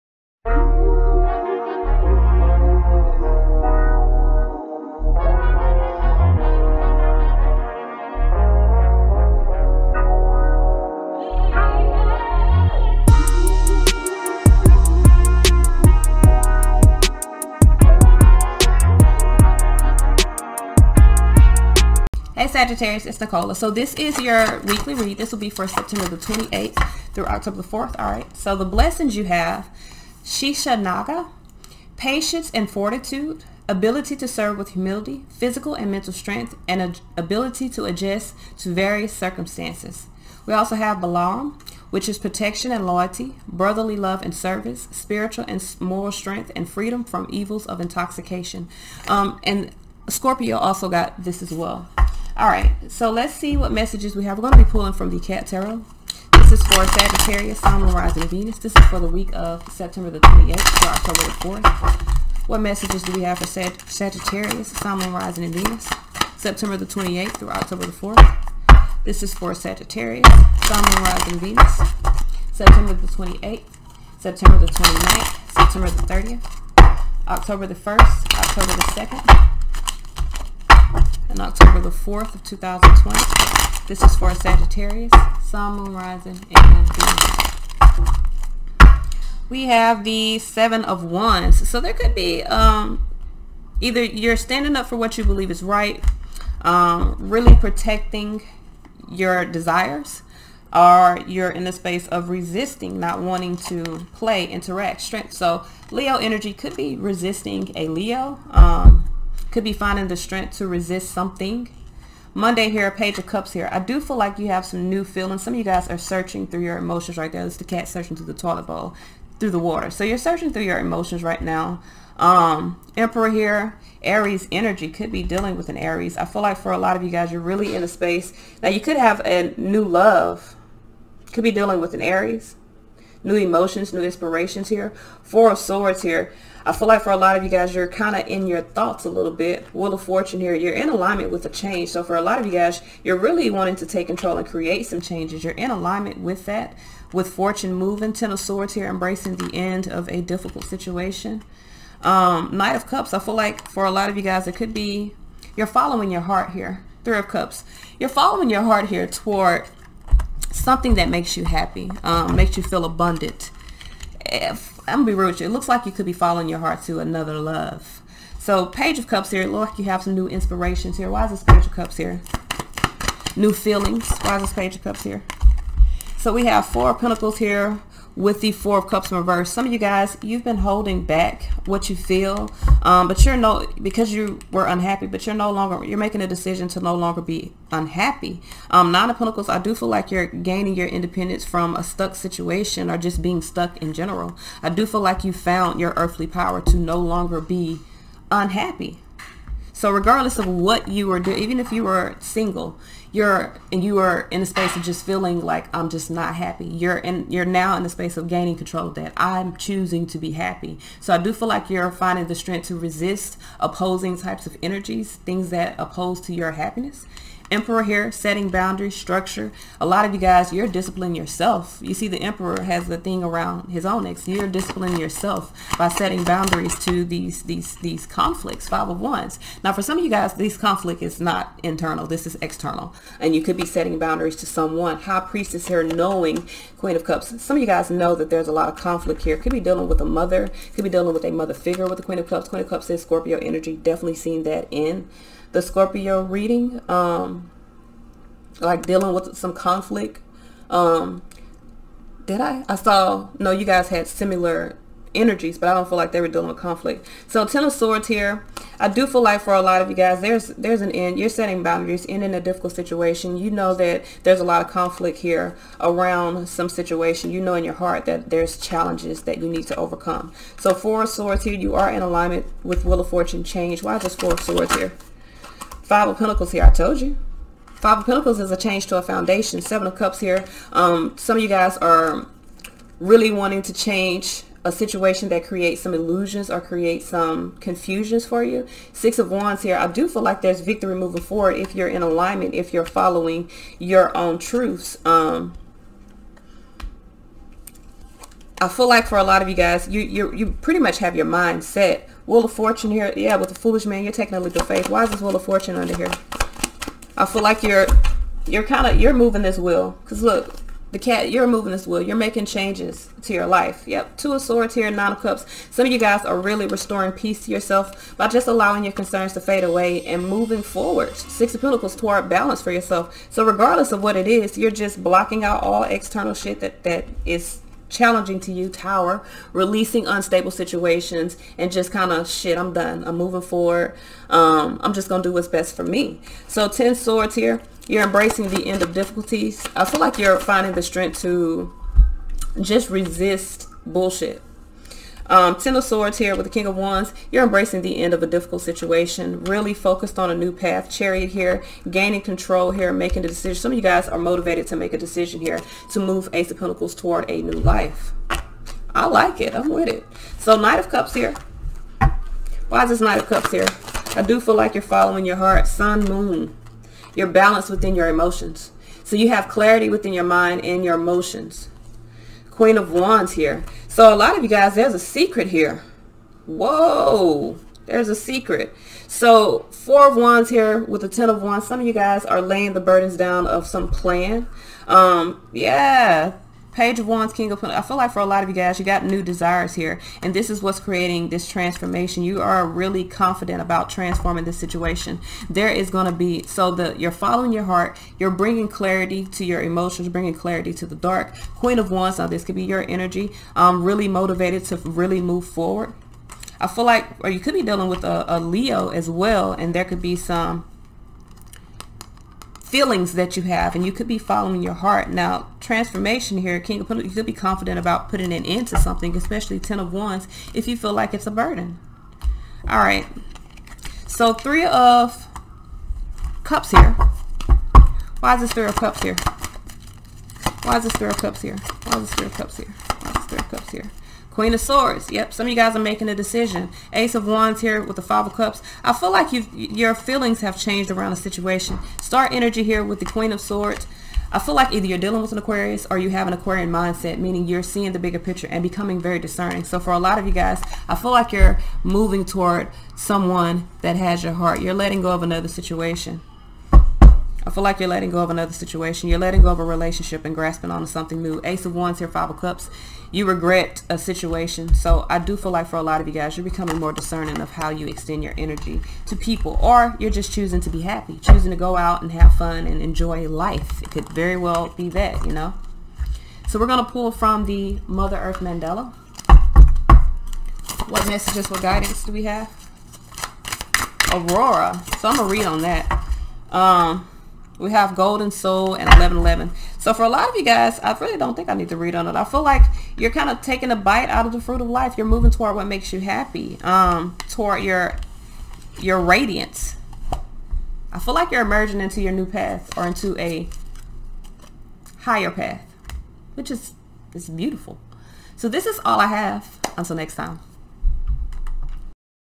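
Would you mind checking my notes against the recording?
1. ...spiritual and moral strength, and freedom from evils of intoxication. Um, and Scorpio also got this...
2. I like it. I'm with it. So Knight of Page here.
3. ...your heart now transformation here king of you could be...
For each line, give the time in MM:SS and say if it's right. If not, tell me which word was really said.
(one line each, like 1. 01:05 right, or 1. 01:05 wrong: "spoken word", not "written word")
1. 00:44 right
2. 05:58 wrong: "Cups", not "Page"
3. 06:54 right.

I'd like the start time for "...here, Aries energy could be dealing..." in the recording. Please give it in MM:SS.
02:03.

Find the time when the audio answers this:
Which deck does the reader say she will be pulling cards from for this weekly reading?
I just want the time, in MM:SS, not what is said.
00:55.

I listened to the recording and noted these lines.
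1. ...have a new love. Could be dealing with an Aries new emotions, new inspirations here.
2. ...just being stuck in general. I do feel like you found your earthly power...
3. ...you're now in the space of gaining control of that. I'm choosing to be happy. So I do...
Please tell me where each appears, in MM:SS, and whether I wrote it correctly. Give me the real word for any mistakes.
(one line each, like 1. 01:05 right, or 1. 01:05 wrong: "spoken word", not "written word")
1. 02:08 right
2. 03:12 right
3. 03:27 right.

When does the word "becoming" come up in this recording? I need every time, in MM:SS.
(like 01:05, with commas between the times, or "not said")
07:28, 07:46.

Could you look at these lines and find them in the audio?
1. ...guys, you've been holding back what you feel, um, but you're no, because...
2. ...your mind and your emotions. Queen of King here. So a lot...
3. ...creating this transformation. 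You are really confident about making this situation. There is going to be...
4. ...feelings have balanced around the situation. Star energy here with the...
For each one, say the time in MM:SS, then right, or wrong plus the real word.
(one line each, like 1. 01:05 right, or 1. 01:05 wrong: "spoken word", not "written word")
1. 02:59 right
2. 06:10 wrong: "Wands", not "King"
3. 06:30 wrong: "transforming", not "making"
4. 07:19 wrong: "changed", not "balanced".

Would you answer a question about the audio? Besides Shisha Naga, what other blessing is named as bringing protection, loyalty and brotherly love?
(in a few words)
Balam.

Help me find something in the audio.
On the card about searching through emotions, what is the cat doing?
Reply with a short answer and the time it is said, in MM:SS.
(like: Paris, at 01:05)
searching through the toilet bowl, at 01:57.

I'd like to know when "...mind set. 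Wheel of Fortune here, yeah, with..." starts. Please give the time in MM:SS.
05:01.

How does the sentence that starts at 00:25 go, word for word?
This will be for September the 28th through October the 4th.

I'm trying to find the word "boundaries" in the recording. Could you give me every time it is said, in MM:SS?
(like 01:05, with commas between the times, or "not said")
03:38, 03:46, 03:53, 04:21.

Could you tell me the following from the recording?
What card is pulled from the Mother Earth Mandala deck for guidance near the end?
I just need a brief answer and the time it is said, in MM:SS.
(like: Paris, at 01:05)
Aurora, at 08:04.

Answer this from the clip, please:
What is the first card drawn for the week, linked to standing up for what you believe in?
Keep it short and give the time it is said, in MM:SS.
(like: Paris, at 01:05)
Seven of Wands, at 01:30.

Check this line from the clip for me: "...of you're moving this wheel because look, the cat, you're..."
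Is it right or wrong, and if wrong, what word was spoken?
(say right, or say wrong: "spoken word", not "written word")
right.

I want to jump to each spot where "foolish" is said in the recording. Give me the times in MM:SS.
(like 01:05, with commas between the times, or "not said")
05:03.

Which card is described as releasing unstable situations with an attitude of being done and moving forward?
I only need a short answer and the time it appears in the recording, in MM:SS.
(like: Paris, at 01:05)
Tower, at 05:28.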